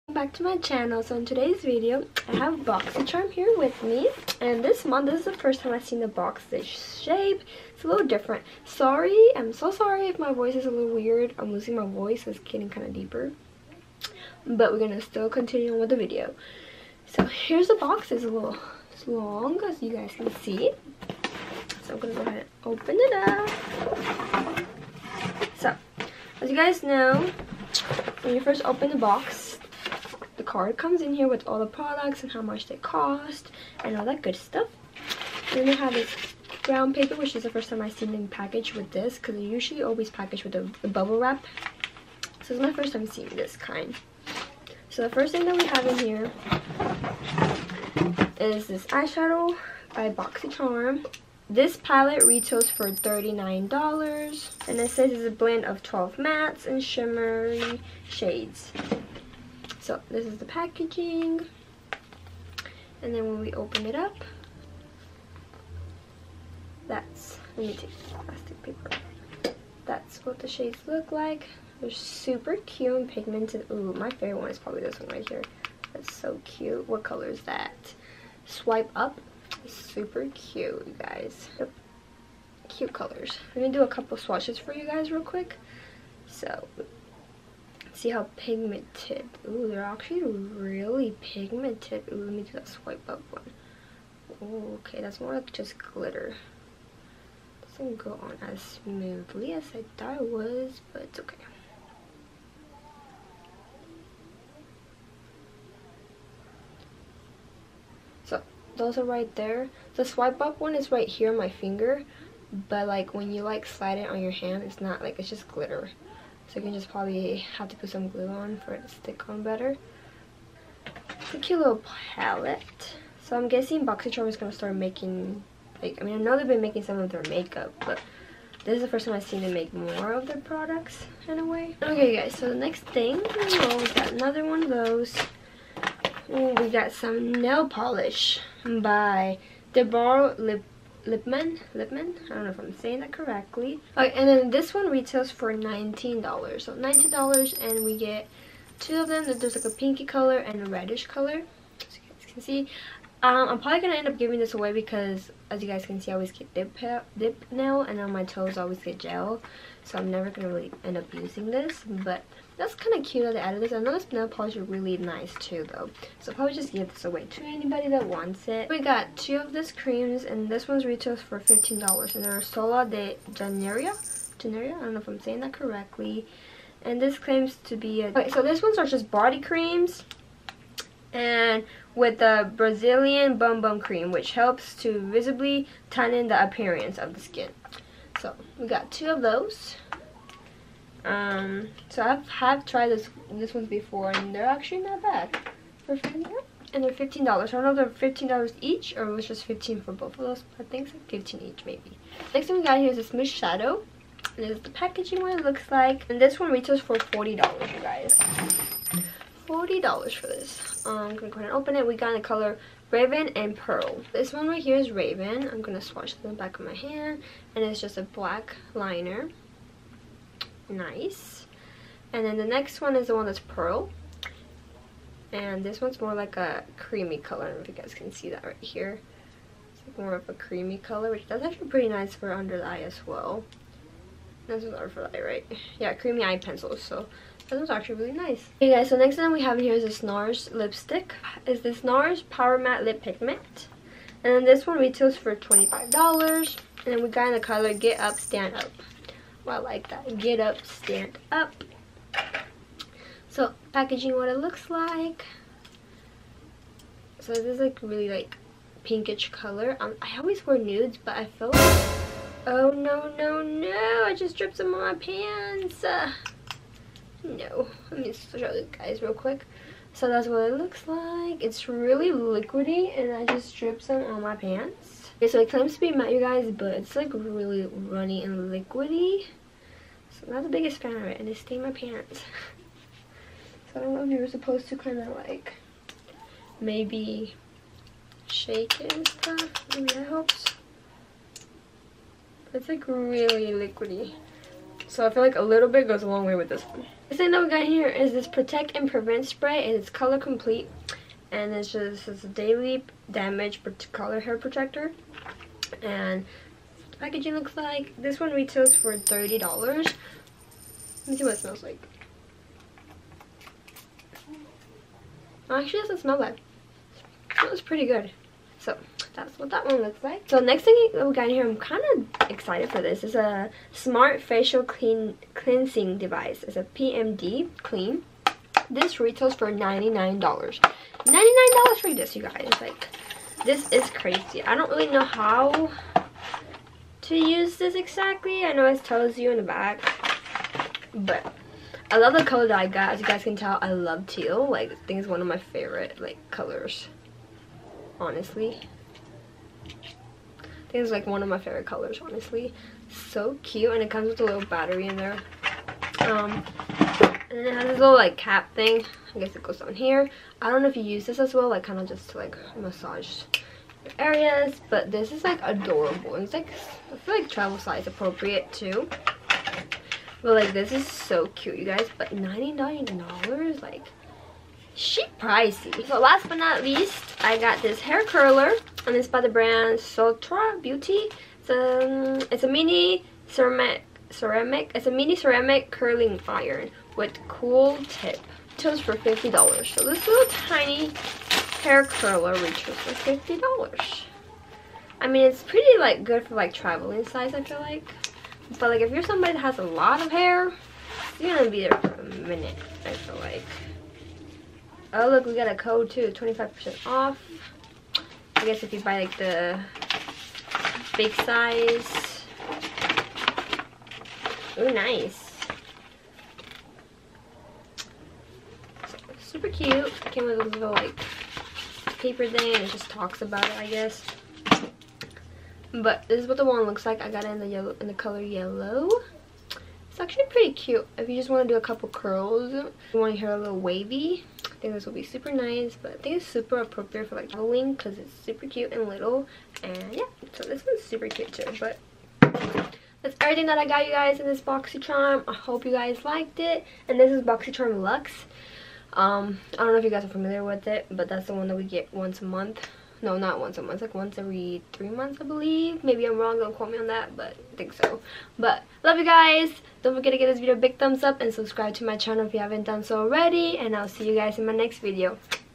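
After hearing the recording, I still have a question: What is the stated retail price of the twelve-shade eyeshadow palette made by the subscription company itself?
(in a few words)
$39.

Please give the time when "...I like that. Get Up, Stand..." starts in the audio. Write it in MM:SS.
04:09.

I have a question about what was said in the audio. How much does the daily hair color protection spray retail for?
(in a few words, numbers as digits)
$30.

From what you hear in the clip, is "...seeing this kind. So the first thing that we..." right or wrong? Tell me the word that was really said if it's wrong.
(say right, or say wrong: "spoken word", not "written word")
right.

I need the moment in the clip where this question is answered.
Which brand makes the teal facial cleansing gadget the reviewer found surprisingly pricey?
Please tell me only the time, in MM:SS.
05:26.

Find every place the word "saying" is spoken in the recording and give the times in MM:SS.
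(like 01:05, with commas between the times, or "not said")
02:22, 02:55.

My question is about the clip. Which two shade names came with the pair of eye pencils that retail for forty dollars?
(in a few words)
Raven and Pearl.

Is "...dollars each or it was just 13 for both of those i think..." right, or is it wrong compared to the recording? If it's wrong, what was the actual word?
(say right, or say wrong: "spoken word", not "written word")
wrong: "15", not "13".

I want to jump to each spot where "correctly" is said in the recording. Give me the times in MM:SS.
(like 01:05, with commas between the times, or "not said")
02:23, 02:55.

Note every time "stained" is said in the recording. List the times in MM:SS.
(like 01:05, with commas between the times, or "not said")
04:41.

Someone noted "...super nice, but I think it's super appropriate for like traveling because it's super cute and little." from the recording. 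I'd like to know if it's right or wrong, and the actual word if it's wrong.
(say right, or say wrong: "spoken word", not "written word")
right.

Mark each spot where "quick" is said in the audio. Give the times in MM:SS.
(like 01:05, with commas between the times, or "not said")
01:25, 04:29.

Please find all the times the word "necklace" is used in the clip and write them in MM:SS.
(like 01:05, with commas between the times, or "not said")
not said.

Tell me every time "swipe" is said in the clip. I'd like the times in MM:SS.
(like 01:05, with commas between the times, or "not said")
01:18, 01:32, 01:50.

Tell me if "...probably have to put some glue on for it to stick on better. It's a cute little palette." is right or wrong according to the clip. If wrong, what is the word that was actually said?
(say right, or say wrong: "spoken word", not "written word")
right.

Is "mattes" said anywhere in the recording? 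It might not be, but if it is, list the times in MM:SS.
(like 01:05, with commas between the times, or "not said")
00:56, 04:02, 04:35.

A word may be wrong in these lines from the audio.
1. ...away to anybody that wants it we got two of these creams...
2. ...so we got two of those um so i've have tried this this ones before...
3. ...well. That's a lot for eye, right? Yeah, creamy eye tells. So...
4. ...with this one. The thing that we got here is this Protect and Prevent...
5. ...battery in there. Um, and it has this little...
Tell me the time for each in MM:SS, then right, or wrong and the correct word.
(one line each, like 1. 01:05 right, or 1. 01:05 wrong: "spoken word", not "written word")
1. 02:47 right
2. 03:08 right
3. 03:53 wrong: "pencils", not "tells"
4. 04:56 right
5. 05:54 right.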